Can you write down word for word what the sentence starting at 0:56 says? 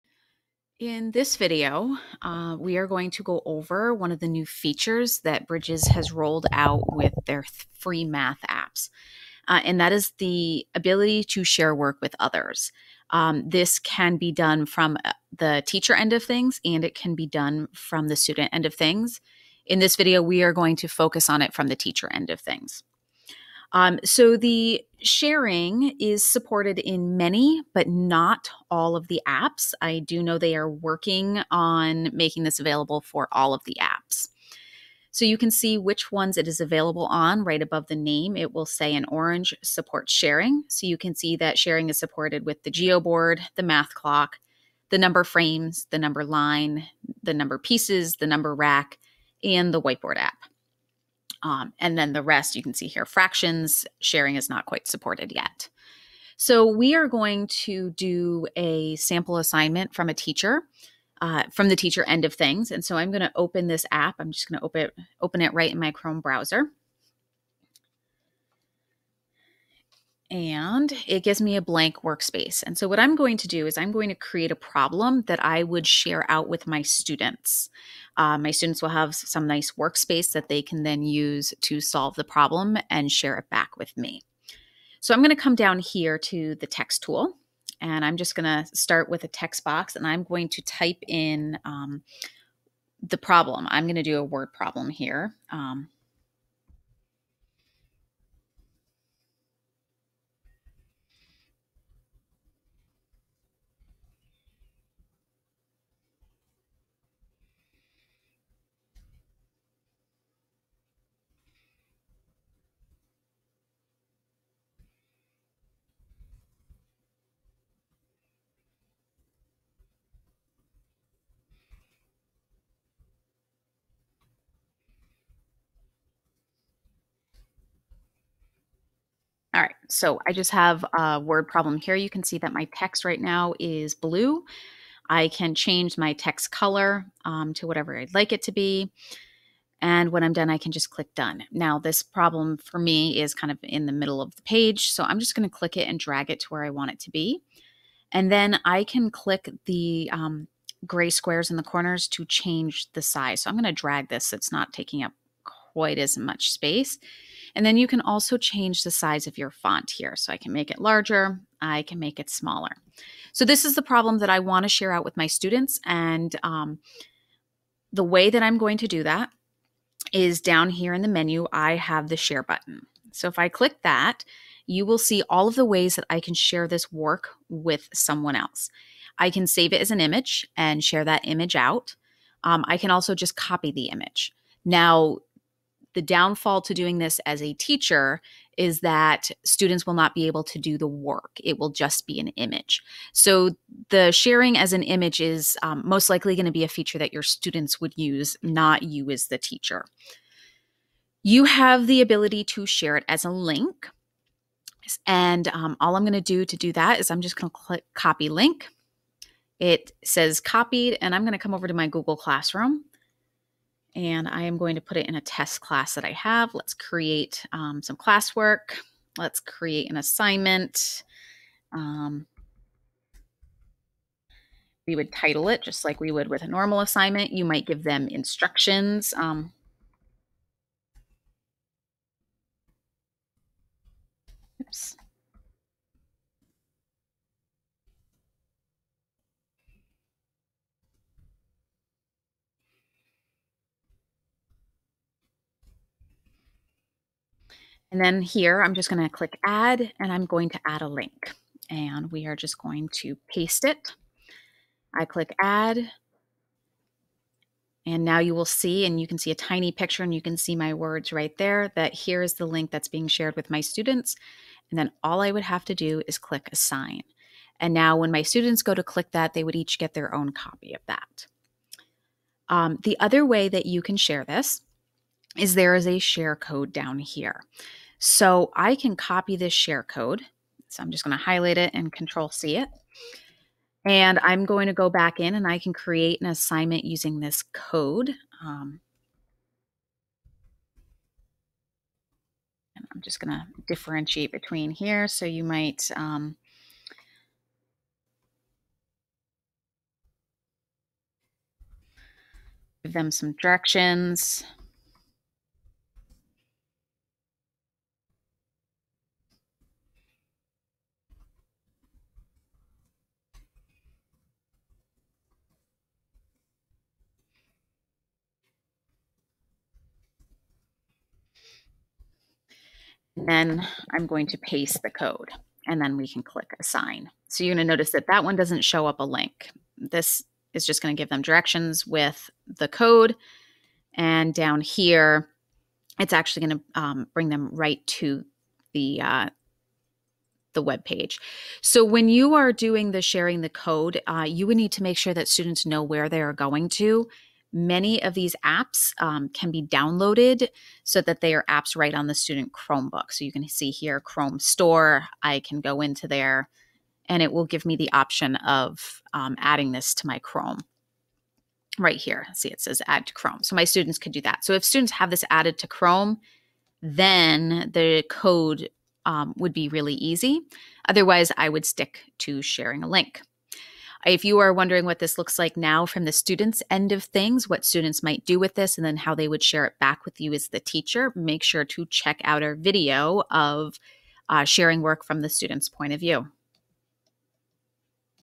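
So we are going to do a sample assignment from a teacher, uh, from the teacher end of things.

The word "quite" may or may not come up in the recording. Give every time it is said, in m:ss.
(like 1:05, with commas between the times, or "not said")
0:54, 2:35.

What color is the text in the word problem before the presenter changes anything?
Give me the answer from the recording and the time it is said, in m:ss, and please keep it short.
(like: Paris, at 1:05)
Blue, at 2:13.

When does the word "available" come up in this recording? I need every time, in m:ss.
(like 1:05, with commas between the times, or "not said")
0:32, 0:36.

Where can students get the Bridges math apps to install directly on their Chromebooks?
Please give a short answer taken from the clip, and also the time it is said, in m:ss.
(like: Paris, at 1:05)
Chrome Store, at 5:53.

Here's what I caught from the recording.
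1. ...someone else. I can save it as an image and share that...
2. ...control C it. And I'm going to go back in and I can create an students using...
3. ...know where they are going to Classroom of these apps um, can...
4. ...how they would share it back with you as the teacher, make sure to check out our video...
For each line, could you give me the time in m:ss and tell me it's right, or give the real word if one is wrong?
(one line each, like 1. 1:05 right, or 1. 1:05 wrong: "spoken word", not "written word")
1. 2:57 right
2. 4:41 wrong: "assignment", not "students"
3. 5:45 wrong: "Many", not "Classroom"
4. 6:18 right.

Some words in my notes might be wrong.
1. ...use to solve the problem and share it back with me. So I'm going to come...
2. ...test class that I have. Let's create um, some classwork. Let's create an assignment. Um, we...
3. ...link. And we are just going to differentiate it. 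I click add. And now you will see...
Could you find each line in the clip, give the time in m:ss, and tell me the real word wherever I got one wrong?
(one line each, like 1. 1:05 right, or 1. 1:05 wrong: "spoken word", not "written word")
1. 1:21 right
2. 3:35 right
3. 4:10 wrong: "paste", not "differentiate".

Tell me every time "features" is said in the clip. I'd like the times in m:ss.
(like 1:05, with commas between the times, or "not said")
0:04, 3:16.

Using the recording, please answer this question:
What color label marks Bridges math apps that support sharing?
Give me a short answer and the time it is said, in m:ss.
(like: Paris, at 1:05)
Orange, at 0:39.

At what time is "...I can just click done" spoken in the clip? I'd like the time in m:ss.
2:20.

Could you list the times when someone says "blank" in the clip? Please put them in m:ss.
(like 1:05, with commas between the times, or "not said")
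1:11.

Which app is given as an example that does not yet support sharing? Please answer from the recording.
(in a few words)
Fractions.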